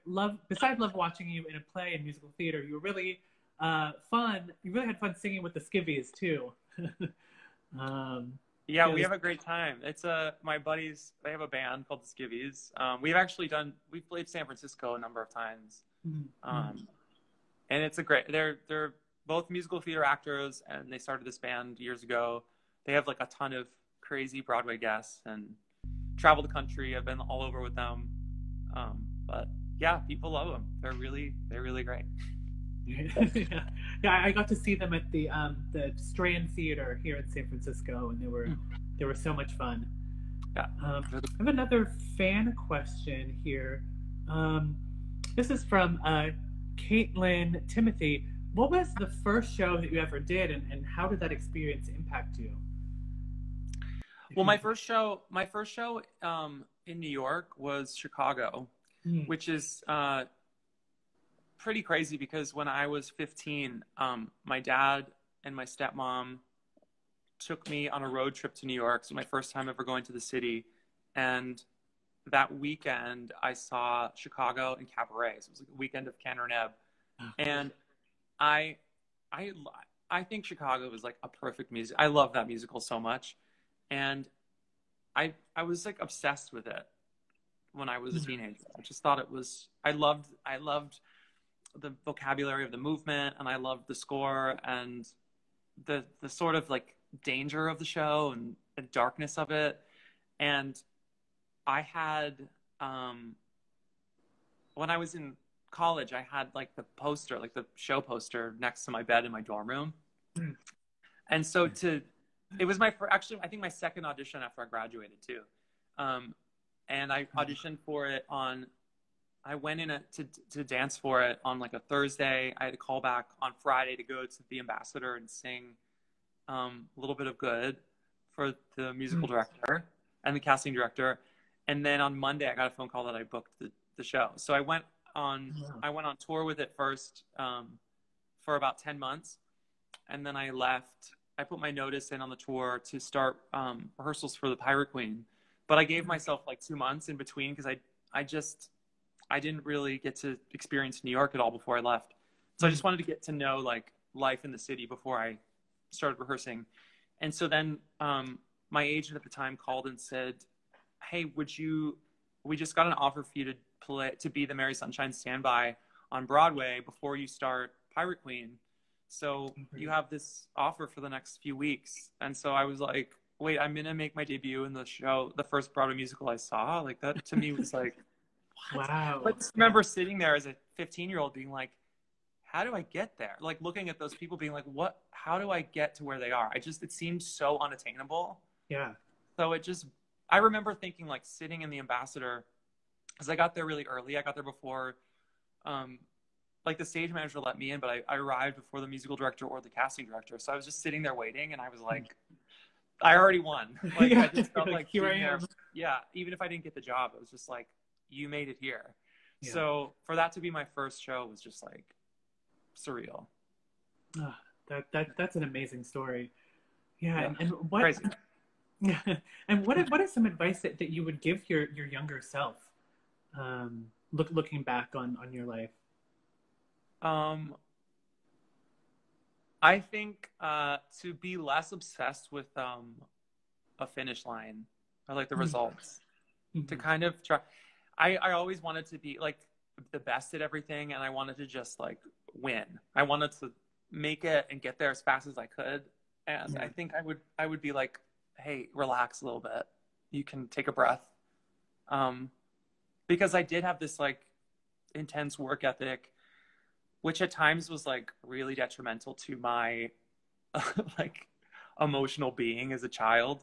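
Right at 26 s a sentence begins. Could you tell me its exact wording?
I've been all over with them, um, but yeah, people love them.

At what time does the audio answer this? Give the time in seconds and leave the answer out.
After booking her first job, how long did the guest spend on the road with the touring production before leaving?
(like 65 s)
138 s.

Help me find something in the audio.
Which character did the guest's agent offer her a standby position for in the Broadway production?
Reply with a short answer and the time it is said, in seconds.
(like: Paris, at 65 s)
Mary Sunshine, at 164 s.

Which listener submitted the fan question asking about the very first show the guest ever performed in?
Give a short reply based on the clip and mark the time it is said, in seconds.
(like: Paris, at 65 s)
Caitlin Timothy, at 46 s.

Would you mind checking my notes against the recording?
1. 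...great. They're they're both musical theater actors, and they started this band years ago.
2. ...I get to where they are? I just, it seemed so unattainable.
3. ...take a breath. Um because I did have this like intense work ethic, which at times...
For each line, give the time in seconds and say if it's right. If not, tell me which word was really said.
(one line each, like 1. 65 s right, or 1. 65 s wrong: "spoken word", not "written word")
1. 18 s right
2. 185 s right
3. 250 s right.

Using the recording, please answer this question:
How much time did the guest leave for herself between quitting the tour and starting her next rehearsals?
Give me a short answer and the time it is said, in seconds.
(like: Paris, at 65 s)
2 months, at 146 s.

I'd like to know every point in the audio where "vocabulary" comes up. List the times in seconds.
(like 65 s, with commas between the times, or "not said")
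92 s.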